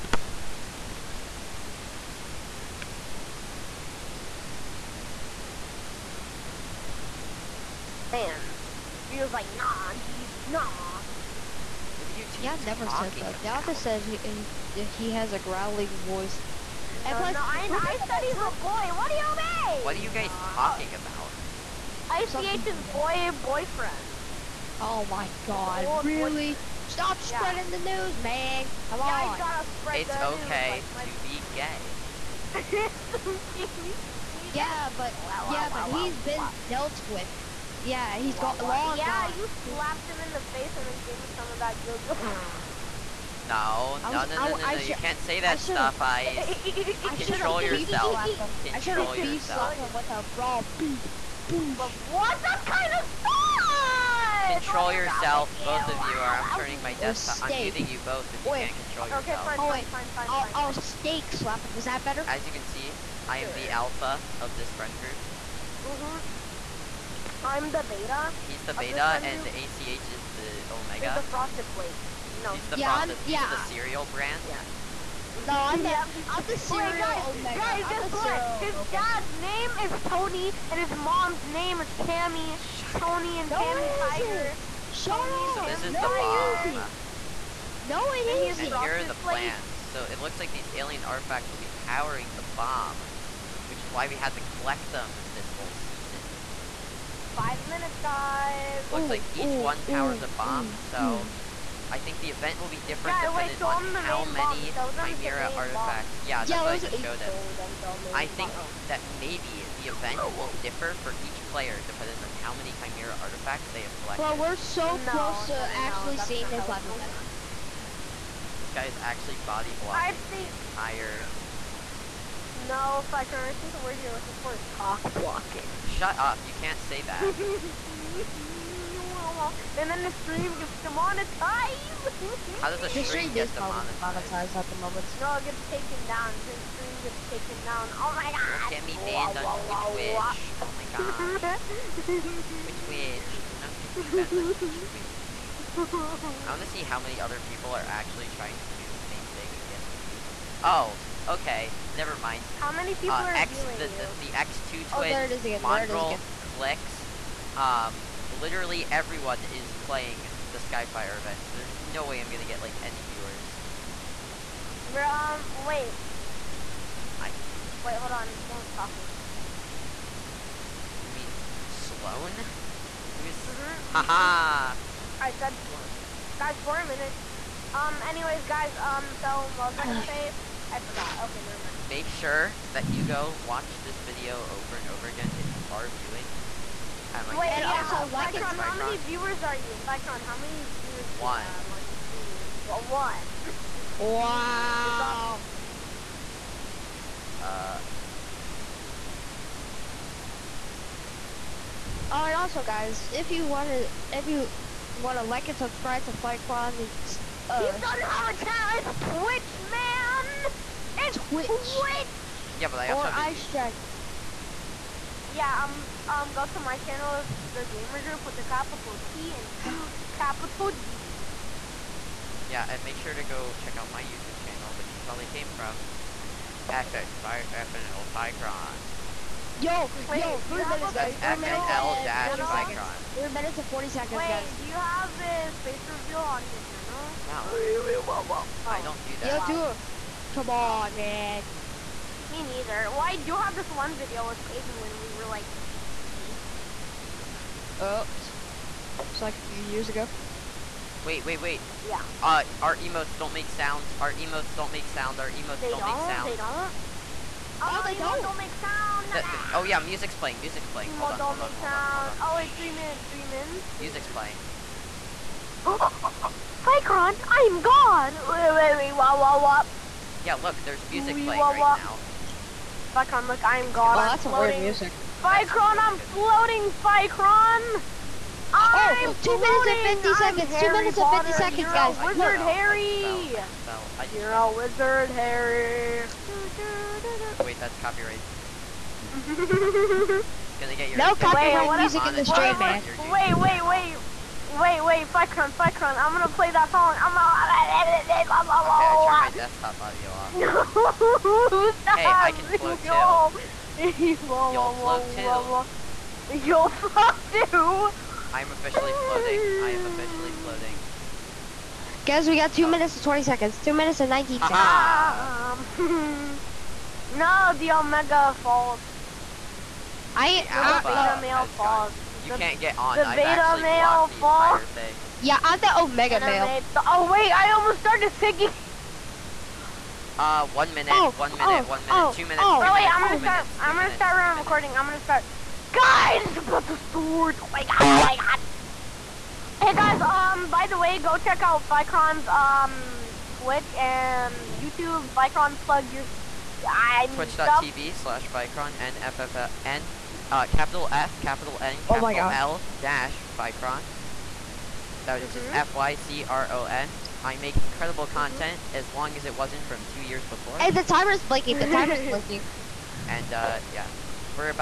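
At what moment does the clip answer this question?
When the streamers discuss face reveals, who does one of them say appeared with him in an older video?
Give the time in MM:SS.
04:04.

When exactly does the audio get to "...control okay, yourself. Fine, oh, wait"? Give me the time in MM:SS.
00:58.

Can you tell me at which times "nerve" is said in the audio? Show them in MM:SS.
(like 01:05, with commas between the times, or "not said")
not said.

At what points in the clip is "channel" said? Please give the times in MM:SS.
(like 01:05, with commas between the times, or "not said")
03:07, 03:28, 03:36, 03:44, 03:56.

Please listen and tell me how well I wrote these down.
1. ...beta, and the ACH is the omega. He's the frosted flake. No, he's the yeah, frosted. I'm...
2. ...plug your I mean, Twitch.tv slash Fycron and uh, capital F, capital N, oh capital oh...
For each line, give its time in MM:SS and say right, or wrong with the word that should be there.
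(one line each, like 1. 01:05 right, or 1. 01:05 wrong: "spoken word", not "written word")
1. 01:08 right
2. 05:45 right.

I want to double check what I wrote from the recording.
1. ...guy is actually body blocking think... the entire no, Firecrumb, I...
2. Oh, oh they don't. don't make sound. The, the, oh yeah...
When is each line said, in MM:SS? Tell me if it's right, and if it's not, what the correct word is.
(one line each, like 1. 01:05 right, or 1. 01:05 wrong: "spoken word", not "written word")
1. 01:58 right
2. 04:17 right.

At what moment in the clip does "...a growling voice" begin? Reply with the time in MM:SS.
00:15.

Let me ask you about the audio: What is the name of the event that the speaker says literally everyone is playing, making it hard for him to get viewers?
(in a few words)
Skyfire event.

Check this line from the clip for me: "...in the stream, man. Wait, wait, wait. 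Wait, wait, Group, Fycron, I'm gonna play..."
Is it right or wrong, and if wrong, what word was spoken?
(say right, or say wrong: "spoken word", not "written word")
wrong: "Fycron", not "Group".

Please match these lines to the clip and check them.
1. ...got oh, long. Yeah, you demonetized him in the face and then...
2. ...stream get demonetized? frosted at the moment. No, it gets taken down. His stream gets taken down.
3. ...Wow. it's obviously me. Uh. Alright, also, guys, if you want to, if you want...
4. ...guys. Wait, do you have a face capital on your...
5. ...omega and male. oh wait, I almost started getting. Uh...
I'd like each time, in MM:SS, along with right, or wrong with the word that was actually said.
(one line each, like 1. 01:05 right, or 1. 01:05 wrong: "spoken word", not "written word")
1. 00:38 wrong: "slapped", not "demonetized"
2. 02:12 wrong: "demonetized", not "frosted"
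3. 03:13 right
4. 03:54 wrong: "reveal", not "capital"
5. 05:25 wrong: "singing", not "getting".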